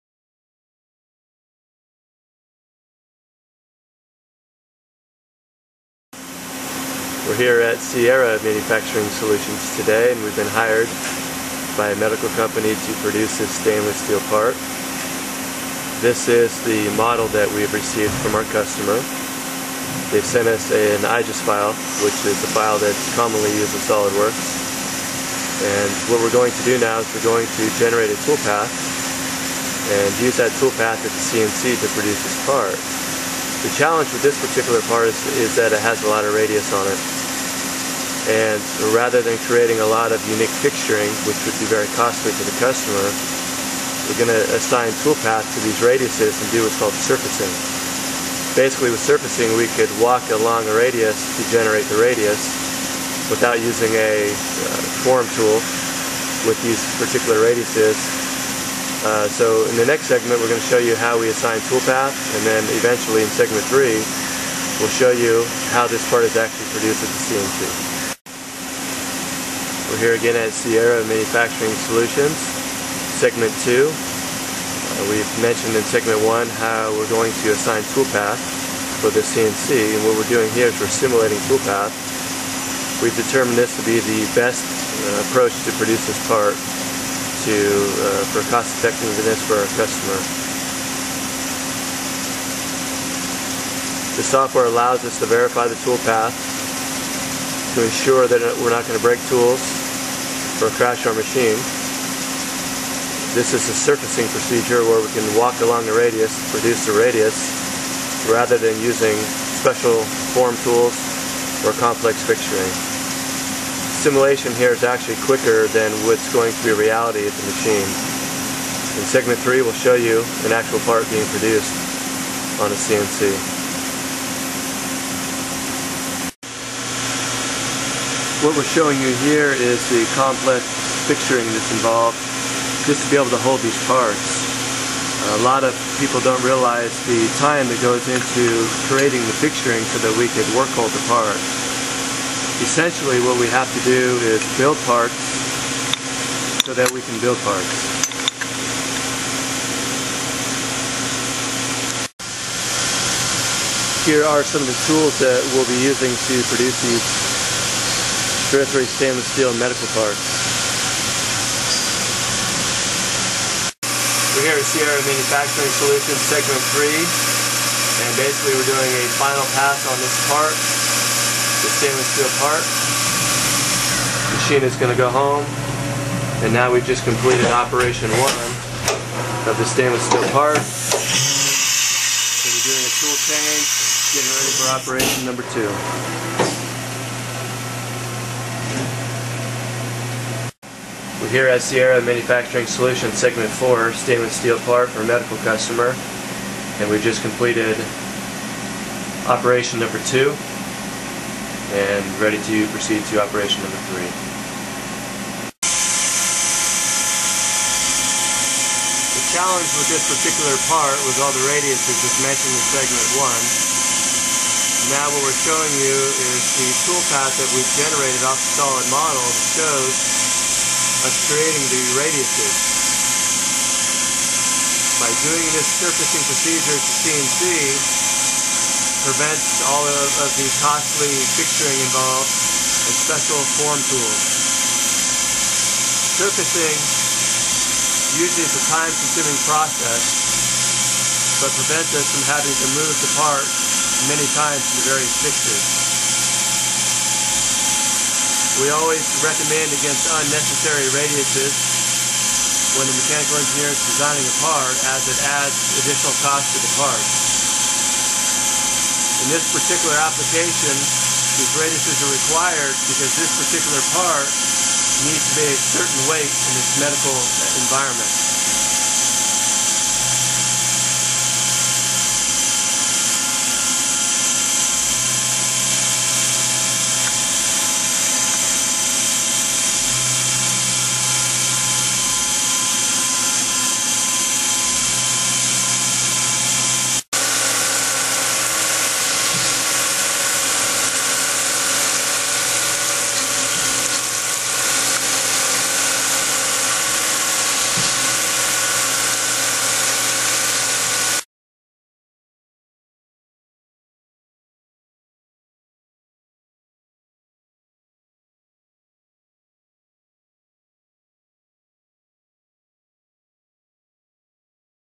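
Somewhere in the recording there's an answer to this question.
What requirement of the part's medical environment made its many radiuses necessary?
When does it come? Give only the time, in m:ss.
4:25.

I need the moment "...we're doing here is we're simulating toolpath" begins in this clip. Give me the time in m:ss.
1:20.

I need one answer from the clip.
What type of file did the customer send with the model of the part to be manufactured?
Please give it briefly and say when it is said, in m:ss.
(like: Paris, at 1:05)
IGES file, at 0:21.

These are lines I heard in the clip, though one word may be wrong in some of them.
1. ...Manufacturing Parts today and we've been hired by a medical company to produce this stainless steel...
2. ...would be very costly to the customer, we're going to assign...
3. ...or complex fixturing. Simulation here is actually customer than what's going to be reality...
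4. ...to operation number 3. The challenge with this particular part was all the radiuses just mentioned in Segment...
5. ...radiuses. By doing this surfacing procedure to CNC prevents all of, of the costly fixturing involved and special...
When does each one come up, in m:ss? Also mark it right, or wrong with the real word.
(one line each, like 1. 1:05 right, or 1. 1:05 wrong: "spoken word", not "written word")
1. 0:08 wrong: "Solutions", not "Parts"
2. 0:41 right
3. 1:51 wrong: "quicker", not "customer"
4. 3:23 right
5. 3:41 right.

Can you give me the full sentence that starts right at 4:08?
We always recommend against unnecessary radiuses when the mechanical engineer is designing a part as it adds additional cost to the part.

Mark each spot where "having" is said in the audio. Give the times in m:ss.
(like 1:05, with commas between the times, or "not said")
4:02.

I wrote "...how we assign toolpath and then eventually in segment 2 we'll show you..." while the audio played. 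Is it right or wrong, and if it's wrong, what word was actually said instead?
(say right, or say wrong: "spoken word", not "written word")
wrong: "3", not "2".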